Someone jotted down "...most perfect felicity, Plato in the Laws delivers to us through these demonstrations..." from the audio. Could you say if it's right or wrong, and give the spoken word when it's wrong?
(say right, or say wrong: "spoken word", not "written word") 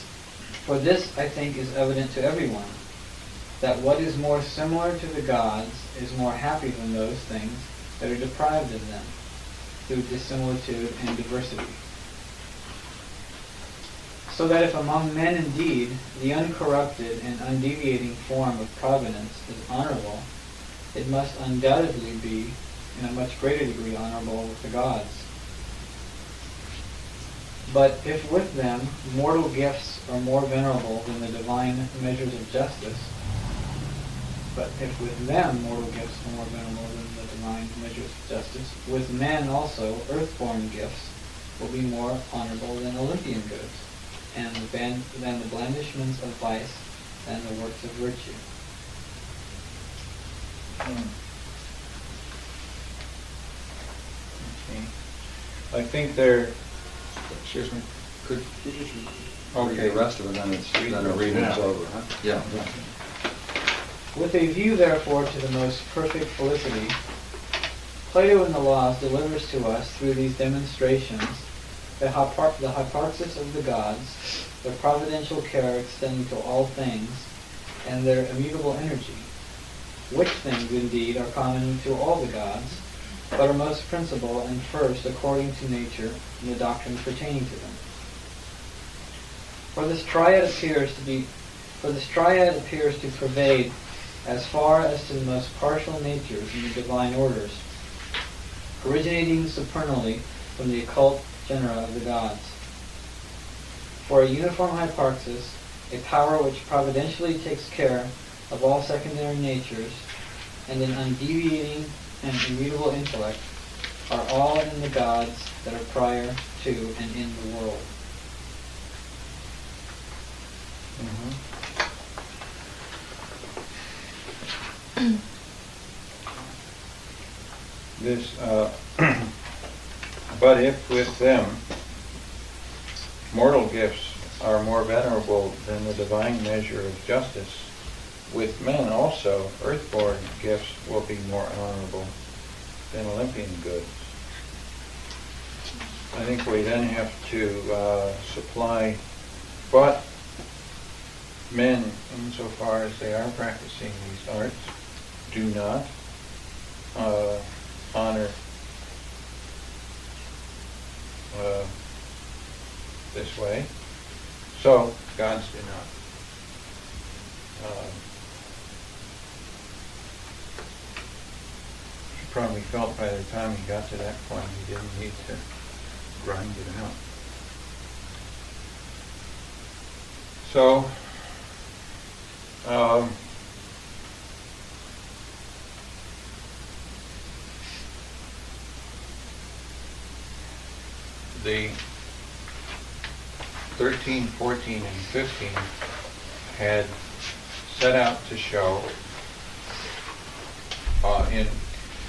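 right.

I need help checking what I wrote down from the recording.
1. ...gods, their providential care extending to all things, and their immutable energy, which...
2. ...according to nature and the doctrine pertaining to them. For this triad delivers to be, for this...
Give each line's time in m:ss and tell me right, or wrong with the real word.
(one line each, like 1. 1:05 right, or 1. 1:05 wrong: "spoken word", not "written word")
1. 1:13 right
2. 1:25 wrong: "appears", not "delivers".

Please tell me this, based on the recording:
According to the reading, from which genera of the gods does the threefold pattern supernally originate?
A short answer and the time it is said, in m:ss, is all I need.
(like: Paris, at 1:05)
occult genera, at 1:40.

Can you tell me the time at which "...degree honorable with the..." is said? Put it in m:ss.
0:23.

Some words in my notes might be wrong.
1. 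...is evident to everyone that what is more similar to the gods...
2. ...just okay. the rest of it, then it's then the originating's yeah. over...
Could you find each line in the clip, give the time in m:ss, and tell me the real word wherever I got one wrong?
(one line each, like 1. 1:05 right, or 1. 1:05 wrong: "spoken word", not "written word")
1. 0:01 right
2. 0:58 wrong: "reading", not "originating".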